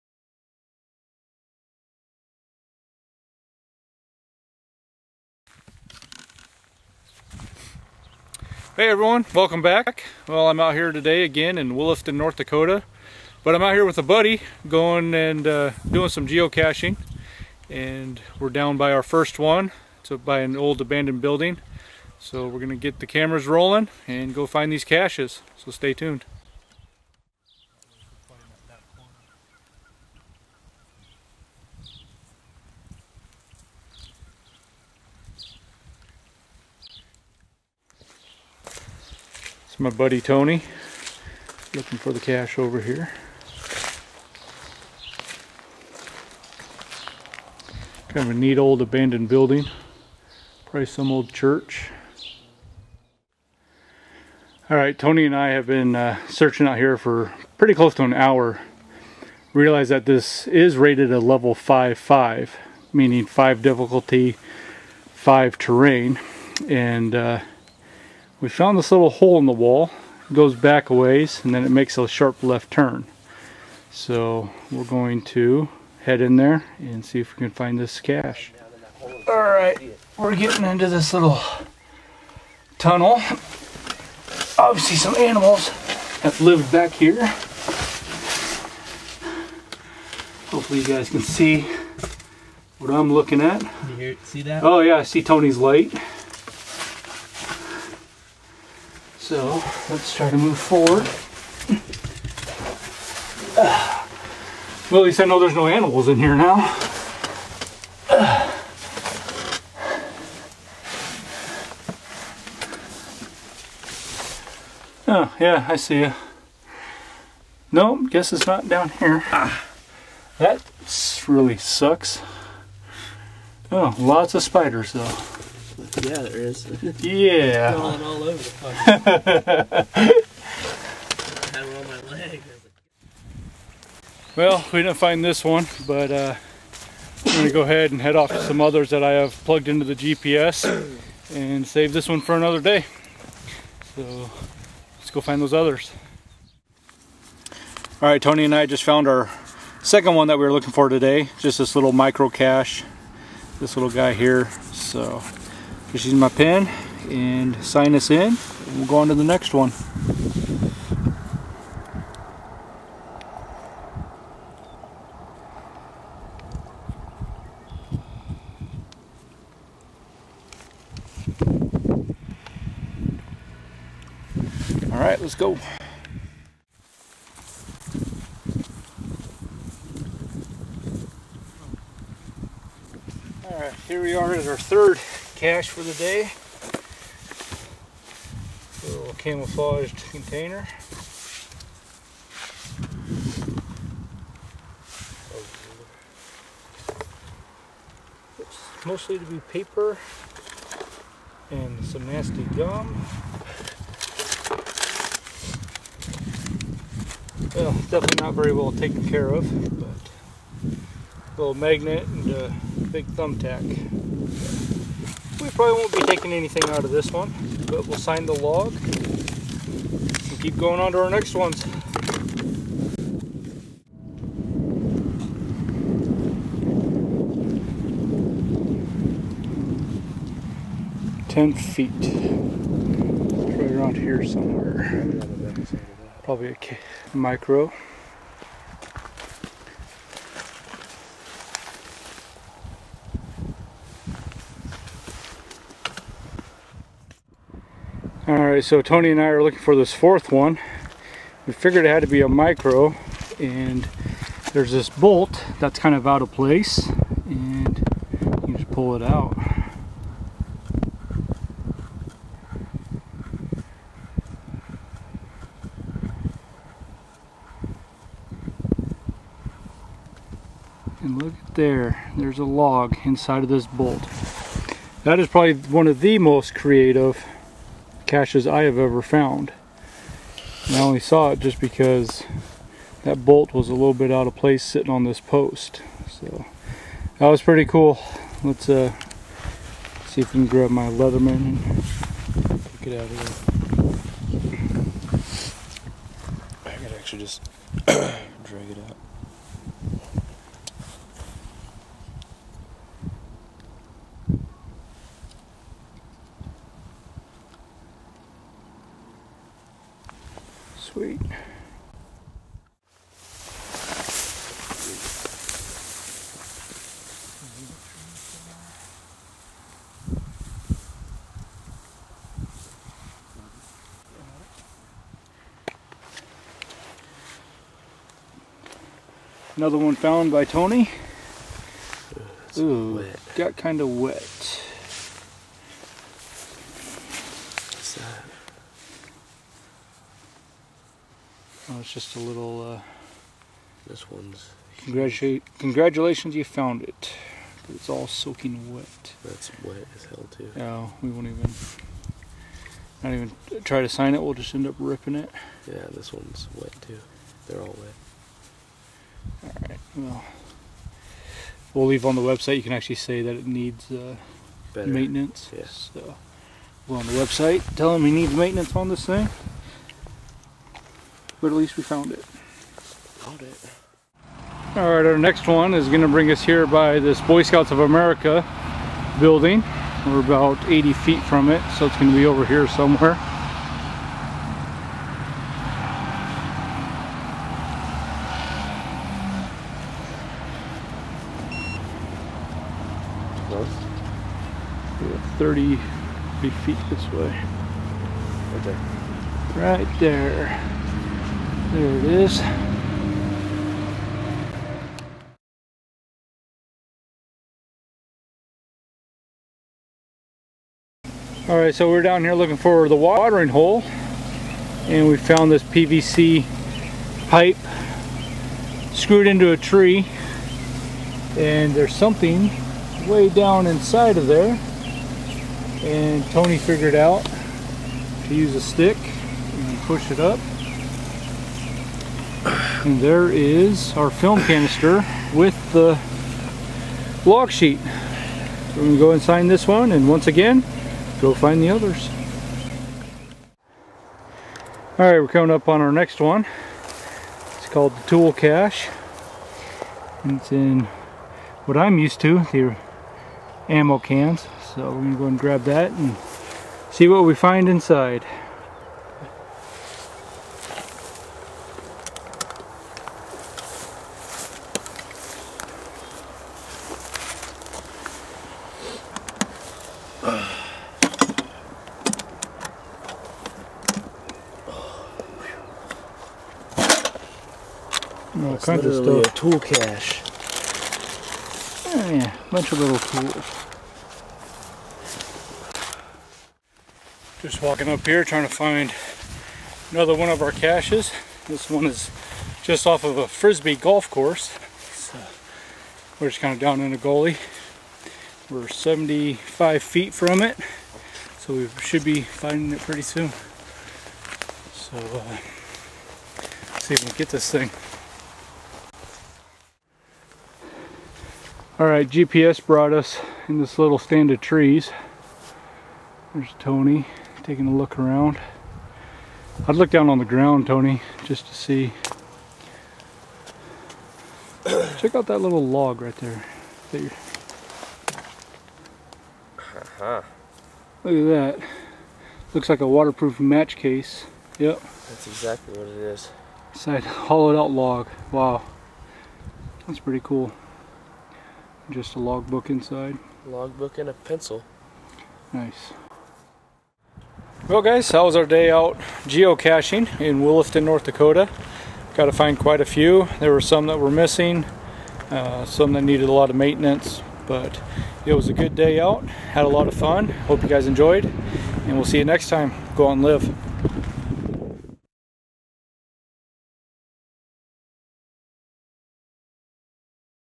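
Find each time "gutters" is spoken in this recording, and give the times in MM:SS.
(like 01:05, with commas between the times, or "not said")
not said.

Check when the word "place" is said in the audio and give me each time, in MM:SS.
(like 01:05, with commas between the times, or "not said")
02:08, 04:16, 04:44.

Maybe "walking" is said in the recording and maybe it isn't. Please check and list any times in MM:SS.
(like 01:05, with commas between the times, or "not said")
08:07.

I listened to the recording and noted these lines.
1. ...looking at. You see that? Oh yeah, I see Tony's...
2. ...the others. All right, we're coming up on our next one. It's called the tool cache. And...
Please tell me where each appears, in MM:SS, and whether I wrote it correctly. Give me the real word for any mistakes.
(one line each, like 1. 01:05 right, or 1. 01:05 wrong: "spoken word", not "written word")
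1. 01:33 right
2. 07:21 right.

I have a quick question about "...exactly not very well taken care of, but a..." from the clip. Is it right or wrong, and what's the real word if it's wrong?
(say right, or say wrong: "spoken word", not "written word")
wrong: "definitely", not "exactly".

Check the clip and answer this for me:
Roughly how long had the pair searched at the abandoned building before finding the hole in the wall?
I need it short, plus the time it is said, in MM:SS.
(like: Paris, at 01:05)
close to an hour, at 00:57.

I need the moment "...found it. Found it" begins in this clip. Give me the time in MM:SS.
06:11.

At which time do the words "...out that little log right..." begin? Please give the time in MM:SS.
08:45.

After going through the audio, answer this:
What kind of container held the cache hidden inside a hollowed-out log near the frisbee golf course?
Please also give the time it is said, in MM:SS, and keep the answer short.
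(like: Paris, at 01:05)
waterproof match case, at 08:52.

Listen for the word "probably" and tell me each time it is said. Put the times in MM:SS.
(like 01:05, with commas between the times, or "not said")
00:50, 03:35, 03:56, 04:35.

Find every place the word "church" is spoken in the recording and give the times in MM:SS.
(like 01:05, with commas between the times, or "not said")
00:51.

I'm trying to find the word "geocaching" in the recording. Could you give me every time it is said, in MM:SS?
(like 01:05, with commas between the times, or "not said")
00:16, 09:09.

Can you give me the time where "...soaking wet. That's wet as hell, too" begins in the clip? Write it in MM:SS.
05:48.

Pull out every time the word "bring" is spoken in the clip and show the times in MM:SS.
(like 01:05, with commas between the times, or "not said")
06:16.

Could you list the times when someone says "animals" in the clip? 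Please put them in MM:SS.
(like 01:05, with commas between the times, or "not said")
01:25, 01:45.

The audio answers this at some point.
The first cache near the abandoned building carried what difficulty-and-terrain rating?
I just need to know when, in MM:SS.
01:01.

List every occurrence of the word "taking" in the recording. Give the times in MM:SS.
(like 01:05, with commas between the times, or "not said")
03:36, 08:37.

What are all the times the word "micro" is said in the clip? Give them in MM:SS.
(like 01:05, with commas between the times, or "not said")
02:31, 03:57, 04:12.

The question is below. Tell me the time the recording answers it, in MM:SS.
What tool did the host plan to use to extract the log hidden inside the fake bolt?
04:50.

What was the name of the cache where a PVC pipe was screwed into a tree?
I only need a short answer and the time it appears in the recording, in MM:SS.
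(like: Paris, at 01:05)
the watering hole, at 06:52.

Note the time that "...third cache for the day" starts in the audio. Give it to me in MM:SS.
03:04.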